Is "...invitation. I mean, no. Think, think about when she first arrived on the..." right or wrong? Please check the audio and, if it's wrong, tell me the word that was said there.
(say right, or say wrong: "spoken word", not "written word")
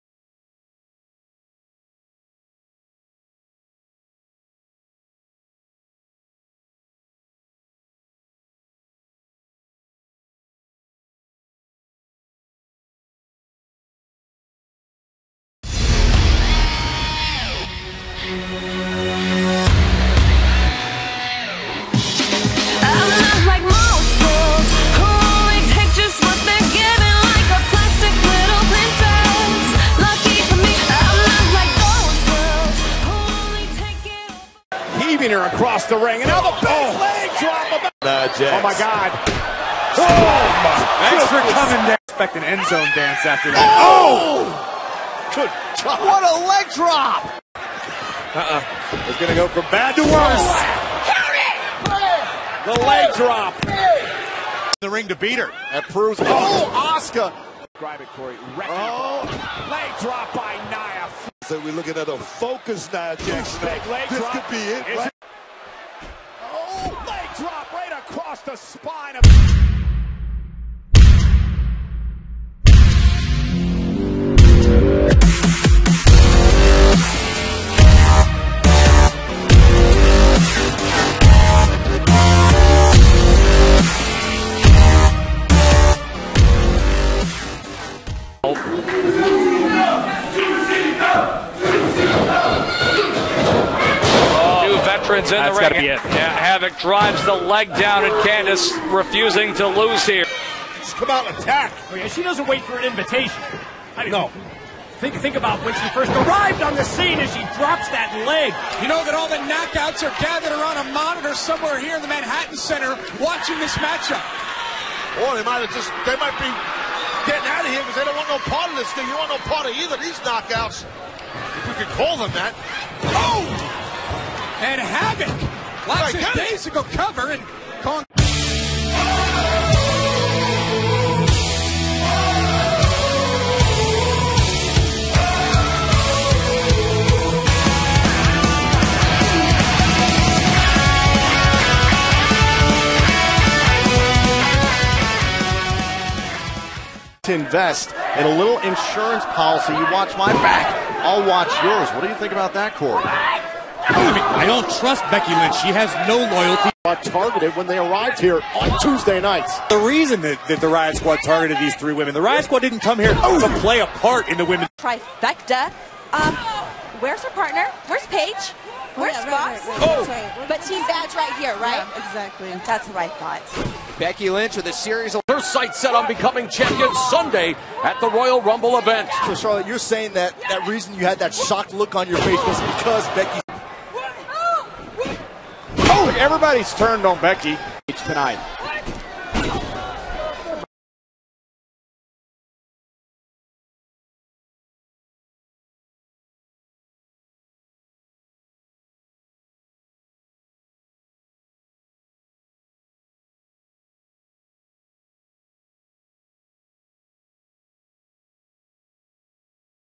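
right.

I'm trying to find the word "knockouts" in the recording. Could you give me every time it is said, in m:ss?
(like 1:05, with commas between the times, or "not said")
1:49, 2:00.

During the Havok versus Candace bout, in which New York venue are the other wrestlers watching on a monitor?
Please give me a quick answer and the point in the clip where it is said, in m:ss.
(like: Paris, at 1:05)
Manhattan Center, at 1:52.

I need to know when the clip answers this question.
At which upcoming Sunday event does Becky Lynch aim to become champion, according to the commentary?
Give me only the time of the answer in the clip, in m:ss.
2:58.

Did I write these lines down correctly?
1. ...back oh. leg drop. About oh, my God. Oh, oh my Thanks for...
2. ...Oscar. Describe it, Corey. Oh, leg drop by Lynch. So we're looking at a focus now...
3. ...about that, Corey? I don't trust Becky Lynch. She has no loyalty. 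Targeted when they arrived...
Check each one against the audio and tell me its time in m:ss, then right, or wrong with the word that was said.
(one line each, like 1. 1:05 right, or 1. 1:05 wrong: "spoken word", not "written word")
1. 0:36 right
2. 0:56 wrong: "Nia", not "Lynch"
3. 2:32 right.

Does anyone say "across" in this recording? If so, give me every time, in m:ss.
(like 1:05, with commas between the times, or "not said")
0:35, 1:07.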